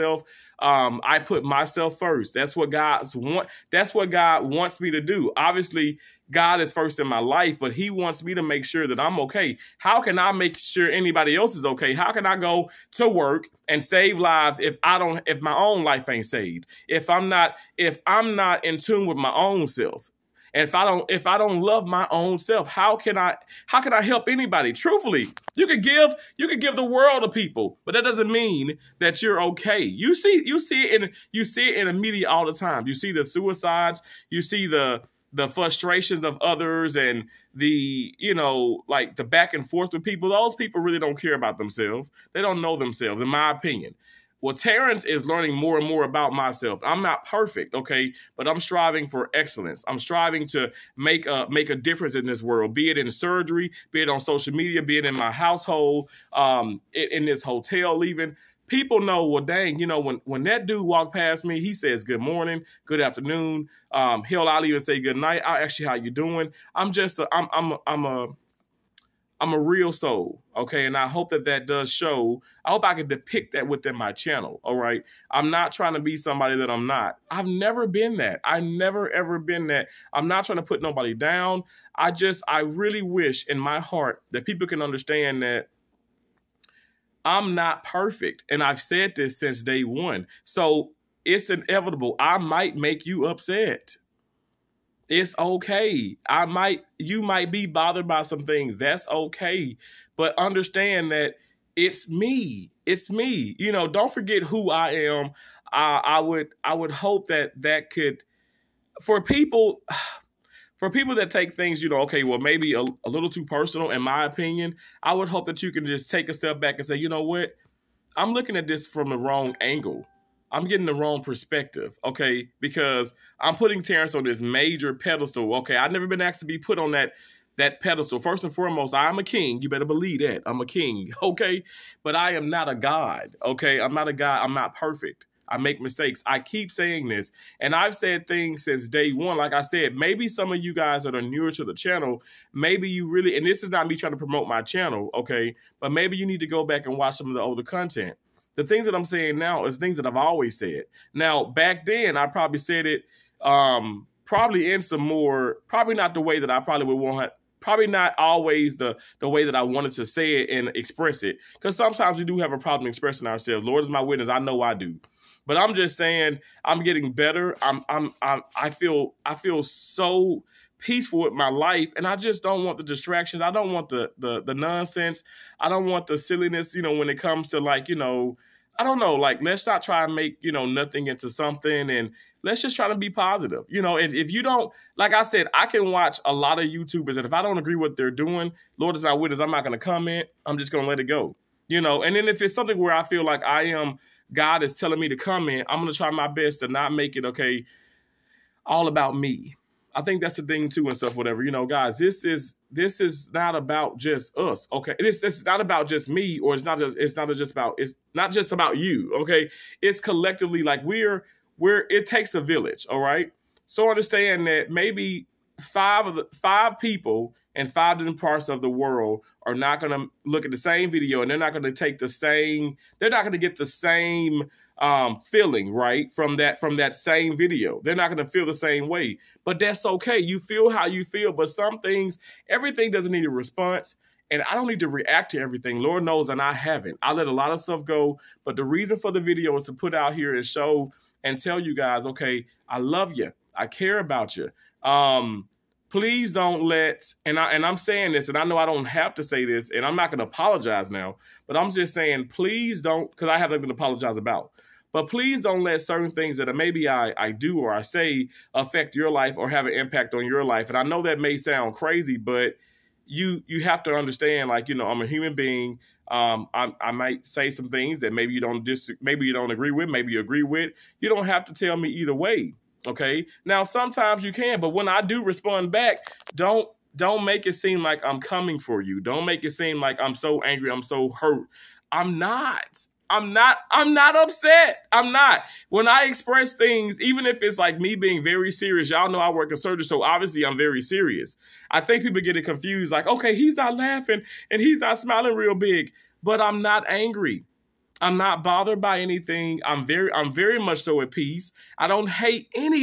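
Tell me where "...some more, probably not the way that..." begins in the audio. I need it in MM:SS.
02:34.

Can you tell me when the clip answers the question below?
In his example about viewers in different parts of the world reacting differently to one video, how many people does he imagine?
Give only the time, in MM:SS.
03:36.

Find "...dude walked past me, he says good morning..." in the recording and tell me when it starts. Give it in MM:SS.
01:00.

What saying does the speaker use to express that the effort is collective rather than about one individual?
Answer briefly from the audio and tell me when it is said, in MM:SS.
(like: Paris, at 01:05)
it takes a village, at 03:31.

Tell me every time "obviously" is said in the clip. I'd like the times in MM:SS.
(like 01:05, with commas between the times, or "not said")
00:05, 04:50.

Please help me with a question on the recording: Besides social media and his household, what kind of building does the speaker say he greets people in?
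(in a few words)
hotel.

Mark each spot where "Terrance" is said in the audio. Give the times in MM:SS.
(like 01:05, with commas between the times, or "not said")
00:44, 02:03.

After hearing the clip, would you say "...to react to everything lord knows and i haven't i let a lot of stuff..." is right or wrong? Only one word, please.
right.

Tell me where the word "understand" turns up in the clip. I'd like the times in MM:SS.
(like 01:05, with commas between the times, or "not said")
01:24, 01:40, 03:33, 04:23.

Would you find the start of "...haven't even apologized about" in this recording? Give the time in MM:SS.
04:13.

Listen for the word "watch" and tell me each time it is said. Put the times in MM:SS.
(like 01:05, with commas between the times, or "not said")
02:26, 03:05.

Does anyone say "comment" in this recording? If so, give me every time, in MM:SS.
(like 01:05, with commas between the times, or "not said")
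03:09, 03:15.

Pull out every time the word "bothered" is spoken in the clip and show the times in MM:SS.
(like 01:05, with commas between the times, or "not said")
01:37, 04:58.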